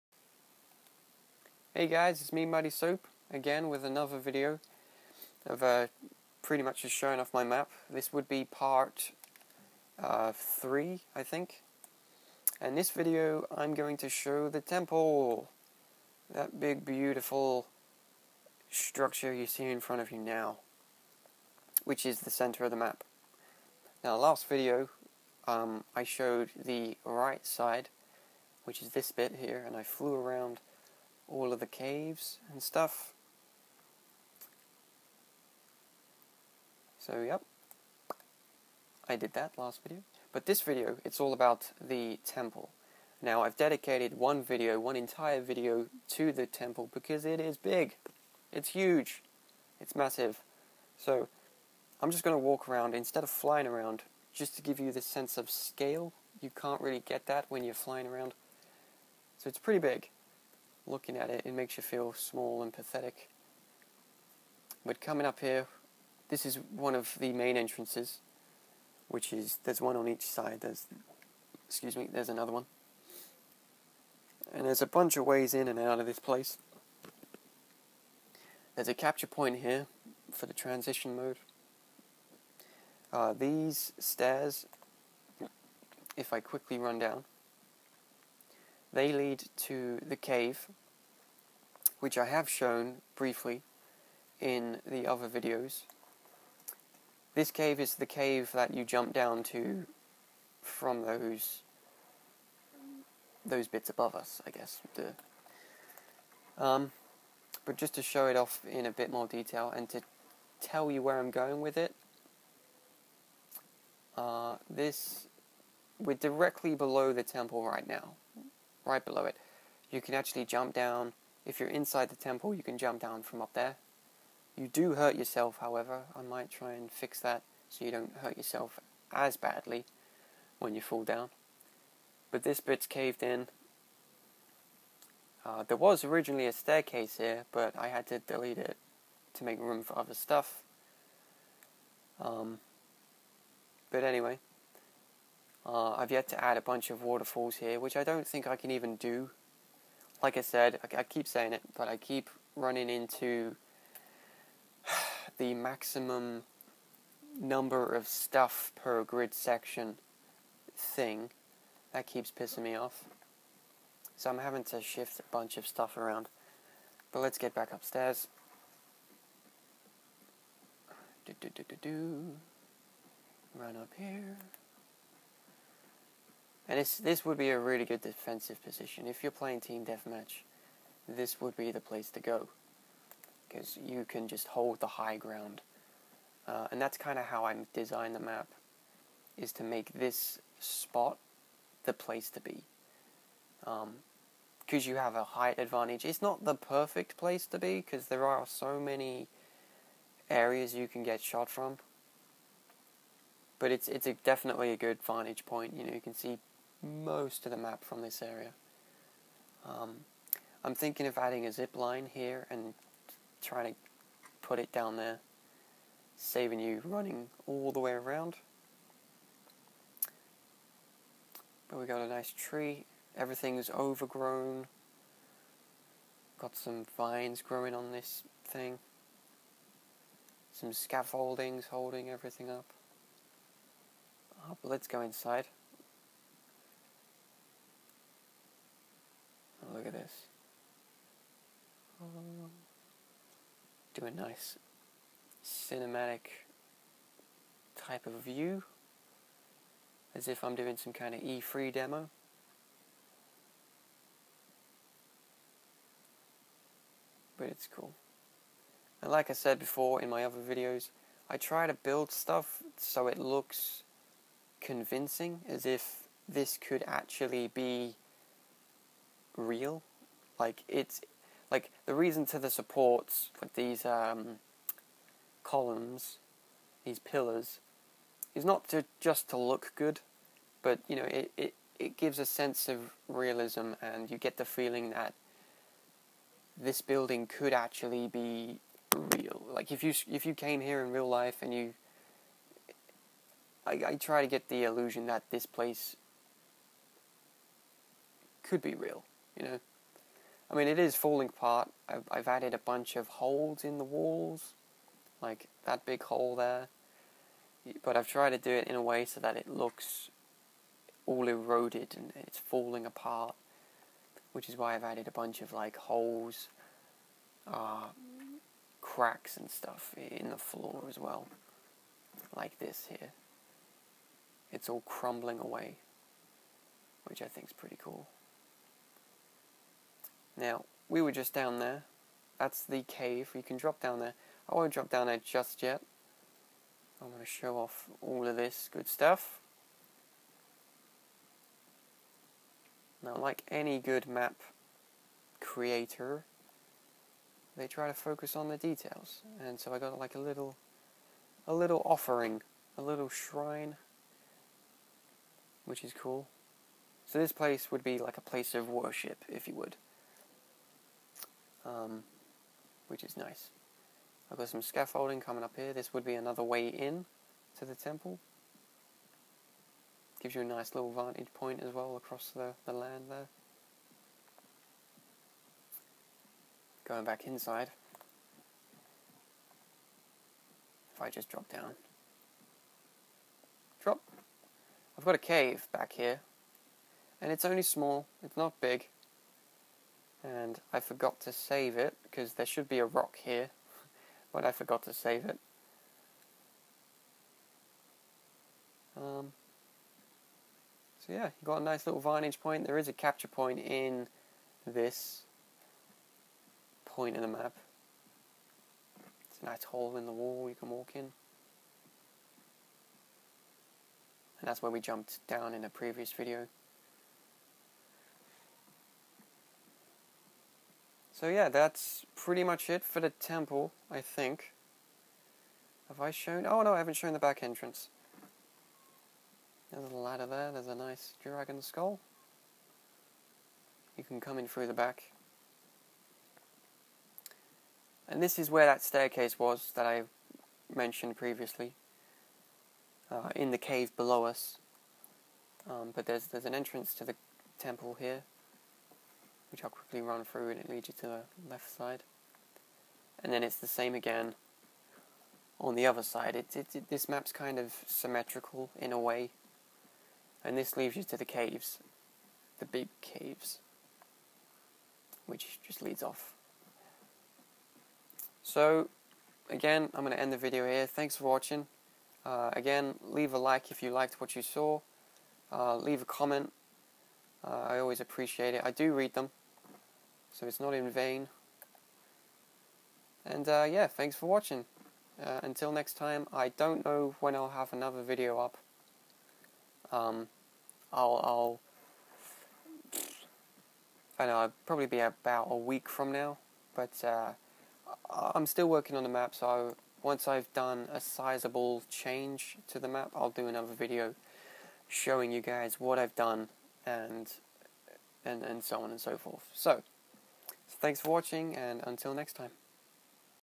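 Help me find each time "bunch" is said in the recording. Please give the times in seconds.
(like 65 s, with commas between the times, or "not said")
74 s, 146 s, 165 s, 302 s, 315 s.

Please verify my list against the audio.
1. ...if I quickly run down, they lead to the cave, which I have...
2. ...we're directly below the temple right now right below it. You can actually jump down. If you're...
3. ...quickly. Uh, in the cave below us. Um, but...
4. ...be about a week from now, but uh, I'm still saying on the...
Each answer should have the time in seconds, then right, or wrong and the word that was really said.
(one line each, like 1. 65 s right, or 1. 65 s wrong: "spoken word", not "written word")
1. 86 s right
2. 115 s right
3. 441 s wrong: "previously", not "quickly"
4. 494 s wrong: "working", not "saying".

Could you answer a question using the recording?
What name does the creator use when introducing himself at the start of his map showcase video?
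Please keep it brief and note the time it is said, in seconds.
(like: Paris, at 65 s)
Muddy Soap, at 2 s.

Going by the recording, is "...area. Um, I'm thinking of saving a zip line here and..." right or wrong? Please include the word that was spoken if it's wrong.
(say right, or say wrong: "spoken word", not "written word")
wrong: "adding", not "saving".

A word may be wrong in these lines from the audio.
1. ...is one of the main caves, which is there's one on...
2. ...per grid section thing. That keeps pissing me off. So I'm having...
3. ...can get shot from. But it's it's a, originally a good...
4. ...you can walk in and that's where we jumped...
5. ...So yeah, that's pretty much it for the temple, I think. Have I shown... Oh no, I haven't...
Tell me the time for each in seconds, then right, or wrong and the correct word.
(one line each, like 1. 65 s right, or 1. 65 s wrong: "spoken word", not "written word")
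1. 66 s wrong: "entrances", not "caves"
2. 158 s right
3. 200 s wrong: "definitely", not "originally"
4. 410 s right
5. 421 s right.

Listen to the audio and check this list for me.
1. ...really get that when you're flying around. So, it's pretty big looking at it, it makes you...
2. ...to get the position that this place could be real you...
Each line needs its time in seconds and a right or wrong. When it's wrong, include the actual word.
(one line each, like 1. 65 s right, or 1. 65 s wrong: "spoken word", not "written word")
1. 56 s right
2. 294 s wrong: "illusion", not "position".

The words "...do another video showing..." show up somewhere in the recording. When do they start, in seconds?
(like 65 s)
503 s.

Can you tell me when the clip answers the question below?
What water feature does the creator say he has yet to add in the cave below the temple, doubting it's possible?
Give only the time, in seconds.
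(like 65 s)
147 s.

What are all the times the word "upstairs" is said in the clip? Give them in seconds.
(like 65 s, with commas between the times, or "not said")
167 s.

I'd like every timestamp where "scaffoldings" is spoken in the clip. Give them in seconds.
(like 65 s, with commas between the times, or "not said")
230 s, 364 s.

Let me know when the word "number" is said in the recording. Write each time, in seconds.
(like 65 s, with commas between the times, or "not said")
157 s.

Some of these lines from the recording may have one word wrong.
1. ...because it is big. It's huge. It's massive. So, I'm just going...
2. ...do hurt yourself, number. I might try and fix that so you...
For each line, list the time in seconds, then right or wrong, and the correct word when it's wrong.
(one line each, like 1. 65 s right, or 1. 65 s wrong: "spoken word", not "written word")
1. 46 s right
2. 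124 s wrong: "however", not "number".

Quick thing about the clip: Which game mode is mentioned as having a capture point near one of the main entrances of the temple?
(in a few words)
Transmission.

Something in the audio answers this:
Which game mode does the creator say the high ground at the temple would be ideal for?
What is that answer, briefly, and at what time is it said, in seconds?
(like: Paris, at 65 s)
Team deathmatch, at 179 s.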